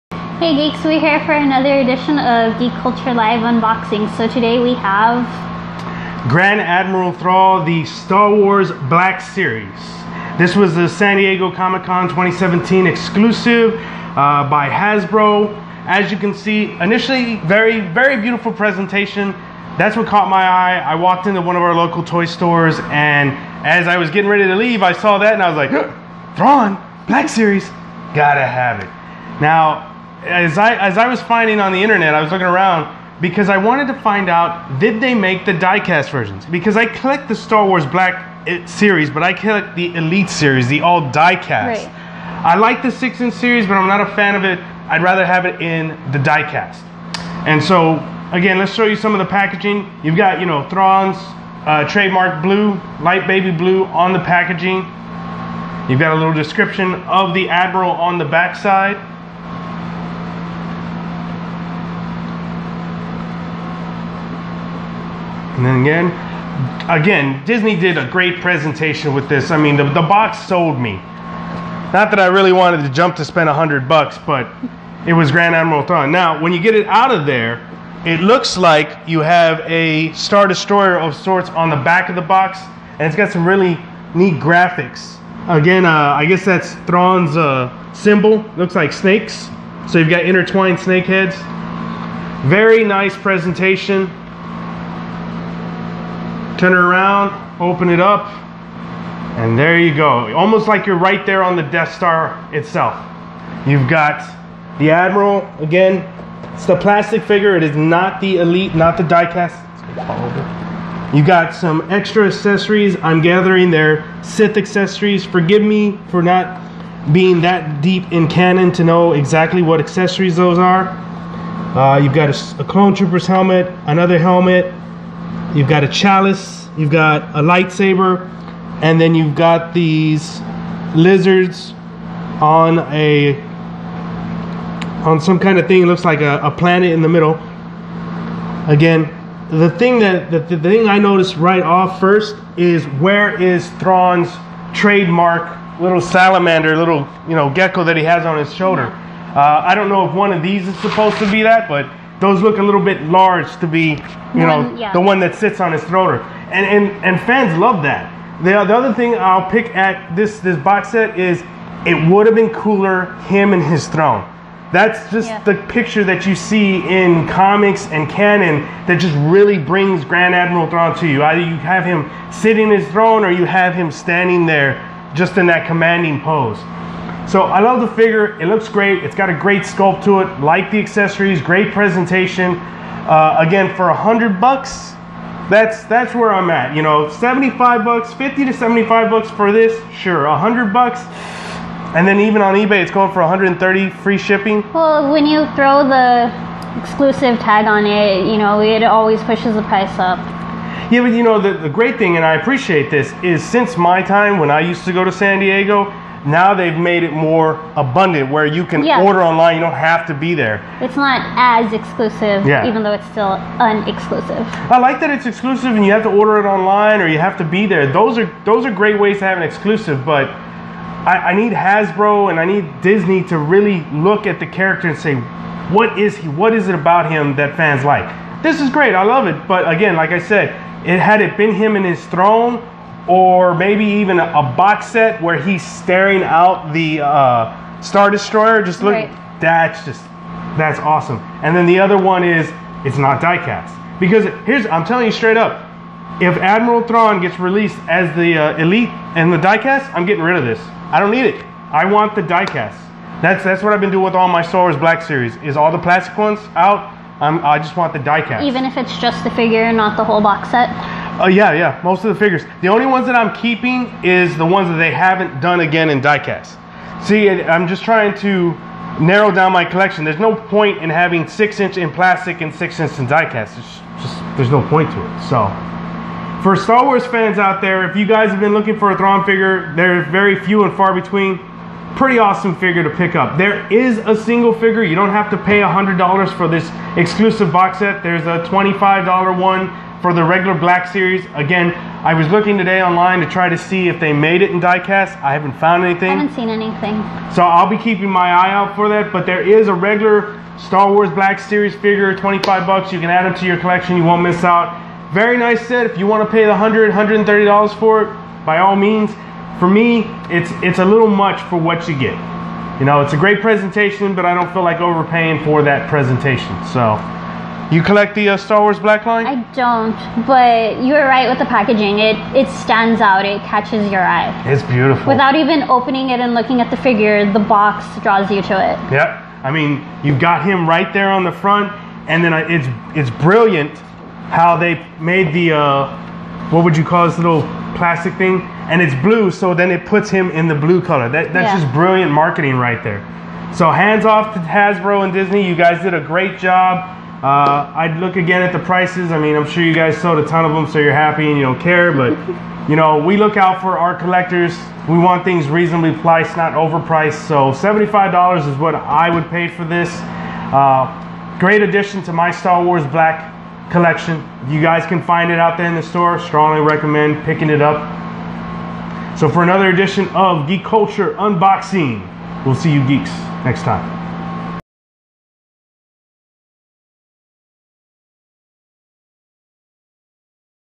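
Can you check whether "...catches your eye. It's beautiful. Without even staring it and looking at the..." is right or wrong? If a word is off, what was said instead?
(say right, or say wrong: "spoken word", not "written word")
wrong: "opening", not "staring".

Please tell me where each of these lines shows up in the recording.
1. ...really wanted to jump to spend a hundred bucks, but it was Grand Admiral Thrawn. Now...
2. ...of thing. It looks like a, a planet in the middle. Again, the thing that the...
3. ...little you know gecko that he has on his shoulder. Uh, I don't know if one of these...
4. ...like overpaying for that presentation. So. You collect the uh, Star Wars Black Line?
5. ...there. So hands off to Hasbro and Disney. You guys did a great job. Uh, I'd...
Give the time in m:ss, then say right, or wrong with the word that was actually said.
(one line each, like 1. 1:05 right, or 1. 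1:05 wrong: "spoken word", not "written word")
1. 1:12 right
2. 2:15 right
3. 2:26 right
4. 5:14 right
5. 5:42 right.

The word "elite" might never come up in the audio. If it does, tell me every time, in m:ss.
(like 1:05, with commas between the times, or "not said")
0:39, 1:48, 4:08.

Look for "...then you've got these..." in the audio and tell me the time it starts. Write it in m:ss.
2:09.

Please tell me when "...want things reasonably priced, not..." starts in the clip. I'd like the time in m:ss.
5:54.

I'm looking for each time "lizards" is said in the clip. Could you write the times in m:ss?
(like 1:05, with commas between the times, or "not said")
2:10.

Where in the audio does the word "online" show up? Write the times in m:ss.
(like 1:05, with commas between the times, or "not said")
3:29, 3:36, 4:52.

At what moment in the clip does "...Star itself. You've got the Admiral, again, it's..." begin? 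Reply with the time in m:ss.
1:41.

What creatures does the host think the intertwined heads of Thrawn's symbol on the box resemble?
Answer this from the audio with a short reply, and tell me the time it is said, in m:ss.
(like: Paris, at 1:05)
Snakes, at 1:28.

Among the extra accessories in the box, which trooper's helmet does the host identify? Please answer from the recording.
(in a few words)
Clone Trooper.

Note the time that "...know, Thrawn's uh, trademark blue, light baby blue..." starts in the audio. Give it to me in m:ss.
0:50.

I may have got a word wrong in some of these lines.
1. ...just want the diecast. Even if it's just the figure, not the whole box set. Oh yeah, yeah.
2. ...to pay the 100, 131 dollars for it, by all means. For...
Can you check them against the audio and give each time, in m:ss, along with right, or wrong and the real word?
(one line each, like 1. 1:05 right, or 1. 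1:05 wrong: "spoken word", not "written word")
1. 4:17 right
2. 5:06 wrong: "130", not "131".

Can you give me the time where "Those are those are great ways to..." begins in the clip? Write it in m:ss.
3:37.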